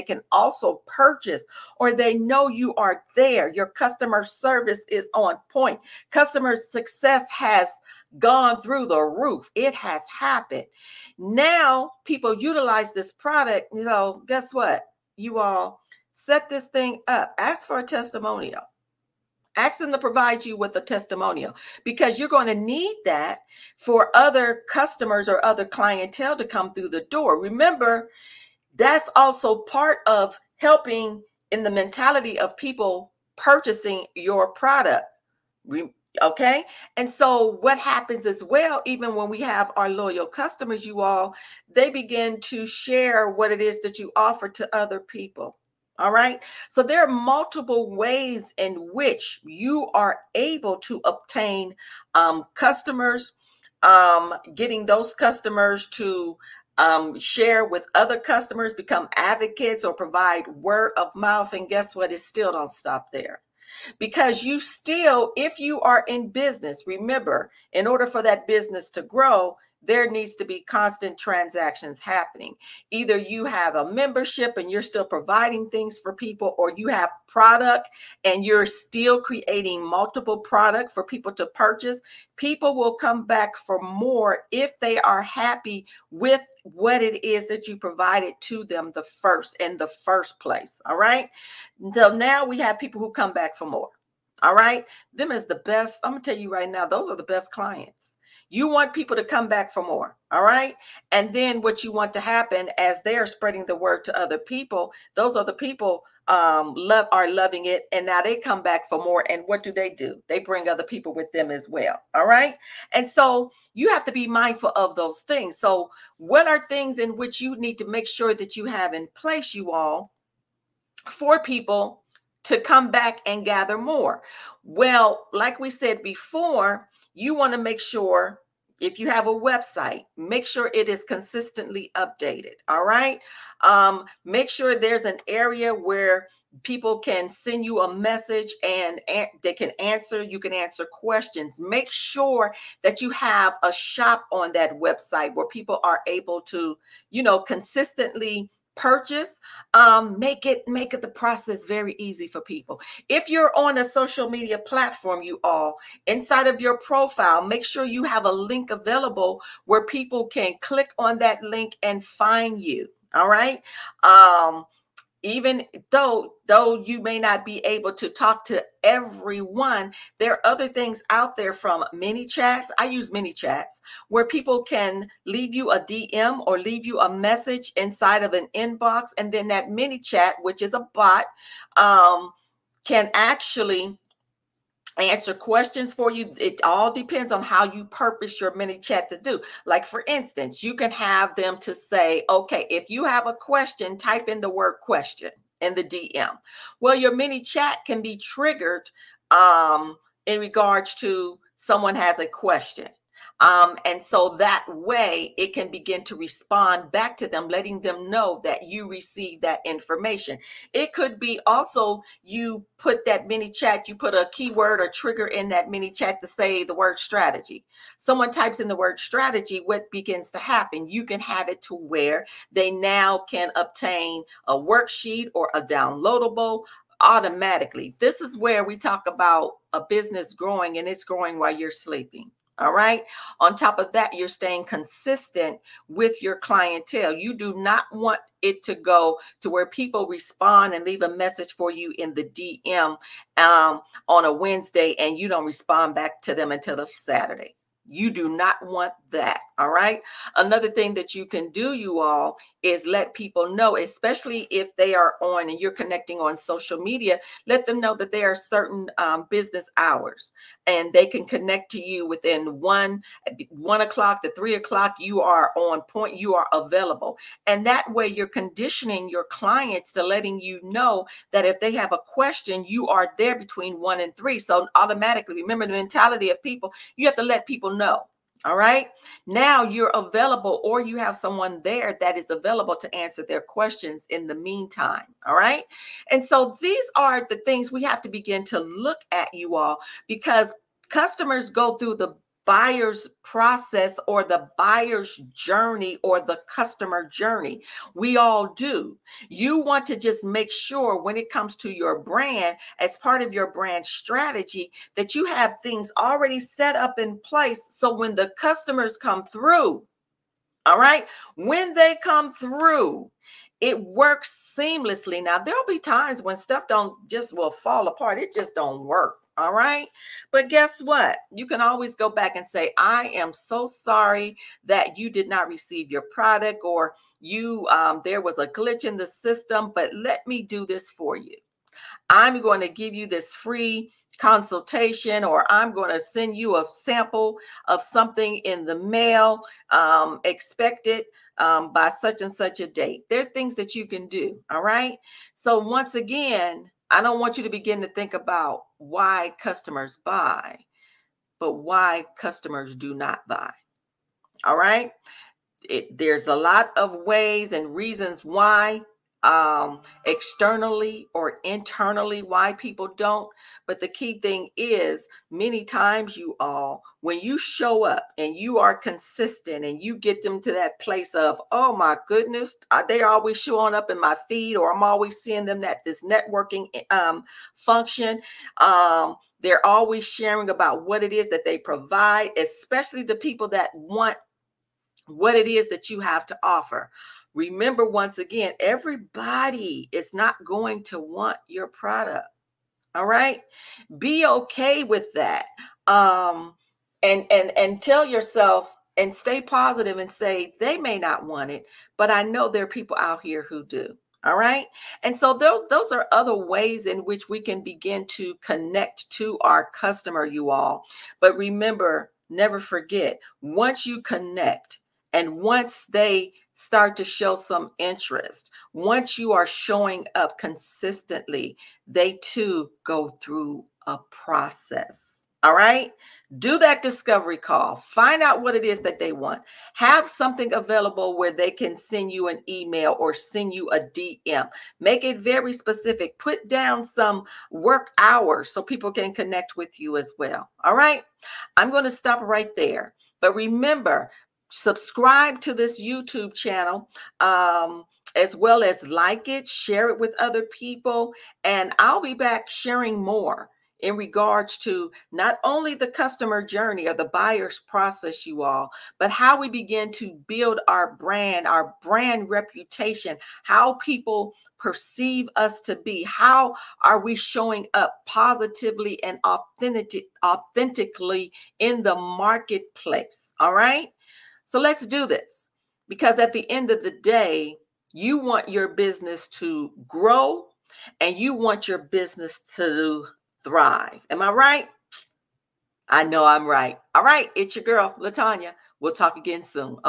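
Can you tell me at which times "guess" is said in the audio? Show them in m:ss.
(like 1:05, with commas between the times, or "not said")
0:14, 1:01, 5:20.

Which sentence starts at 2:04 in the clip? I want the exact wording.
Well, like we said before, you want to make sure if you have a website, make sure it is consistently updated.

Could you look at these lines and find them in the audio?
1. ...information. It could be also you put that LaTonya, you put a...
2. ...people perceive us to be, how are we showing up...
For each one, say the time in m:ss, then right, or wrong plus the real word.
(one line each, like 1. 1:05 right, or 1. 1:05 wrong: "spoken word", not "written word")
1. 3:29 wrong: "ManyChat", not "LaTonya"
2. 7:43 right.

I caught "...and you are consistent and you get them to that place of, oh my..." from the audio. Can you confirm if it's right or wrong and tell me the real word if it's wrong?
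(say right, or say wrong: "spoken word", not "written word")
right.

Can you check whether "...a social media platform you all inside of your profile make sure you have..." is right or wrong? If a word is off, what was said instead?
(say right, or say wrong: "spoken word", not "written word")
right.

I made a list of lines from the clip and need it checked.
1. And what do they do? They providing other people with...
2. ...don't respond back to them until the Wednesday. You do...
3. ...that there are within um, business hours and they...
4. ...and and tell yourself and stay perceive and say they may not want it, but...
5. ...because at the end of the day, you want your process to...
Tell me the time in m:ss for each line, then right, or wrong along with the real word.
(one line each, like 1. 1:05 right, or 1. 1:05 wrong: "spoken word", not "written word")
1. 1:49 wrong: "bring", not "providing"
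2. 4:05 wrong: "Saturday", not "Wednesday"
3. 4:17 wrong: "certain", not "within"
4. 6:37 wrong: "positive", not "perceive"
5. 7:55 wrong: "business", not "process".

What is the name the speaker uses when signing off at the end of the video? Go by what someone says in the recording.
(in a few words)
LaTonya.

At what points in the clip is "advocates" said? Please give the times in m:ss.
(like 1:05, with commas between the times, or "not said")
0:59.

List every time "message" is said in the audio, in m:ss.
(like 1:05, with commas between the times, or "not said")
2:17, 2:57, 4:01.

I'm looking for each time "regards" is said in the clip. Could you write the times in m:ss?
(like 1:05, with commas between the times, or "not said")
3:20, 7:33.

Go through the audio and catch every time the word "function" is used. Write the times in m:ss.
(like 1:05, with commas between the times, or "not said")
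6:17.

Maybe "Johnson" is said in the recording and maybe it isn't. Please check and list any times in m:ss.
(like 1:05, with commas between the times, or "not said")
not said.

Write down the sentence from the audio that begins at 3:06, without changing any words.
It all depends on how you purpose your ManyChat to do.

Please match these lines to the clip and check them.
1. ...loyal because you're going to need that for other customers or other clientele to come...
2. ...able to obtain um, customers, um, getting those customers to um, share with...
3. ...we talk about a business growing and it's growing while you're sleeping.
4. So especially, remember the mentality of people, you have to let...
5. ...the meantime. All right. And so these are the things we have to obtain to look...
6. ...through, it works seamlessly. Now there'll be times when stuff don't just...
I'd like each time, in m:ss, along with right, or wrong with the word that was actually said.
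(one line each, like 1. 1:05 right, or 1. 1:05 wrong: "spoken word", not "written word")
1. 0:20 wrong: "testimonial", not "loyal"
2. 0:50 right
3. 3:48 right
4. 4:34 wrong: "automatically", not "especially"
5. 4:44 wrong: "begin", not "obtain"
6. 5:12 right.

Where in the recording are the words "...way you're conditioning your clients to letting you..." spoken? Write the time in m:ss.
4:27.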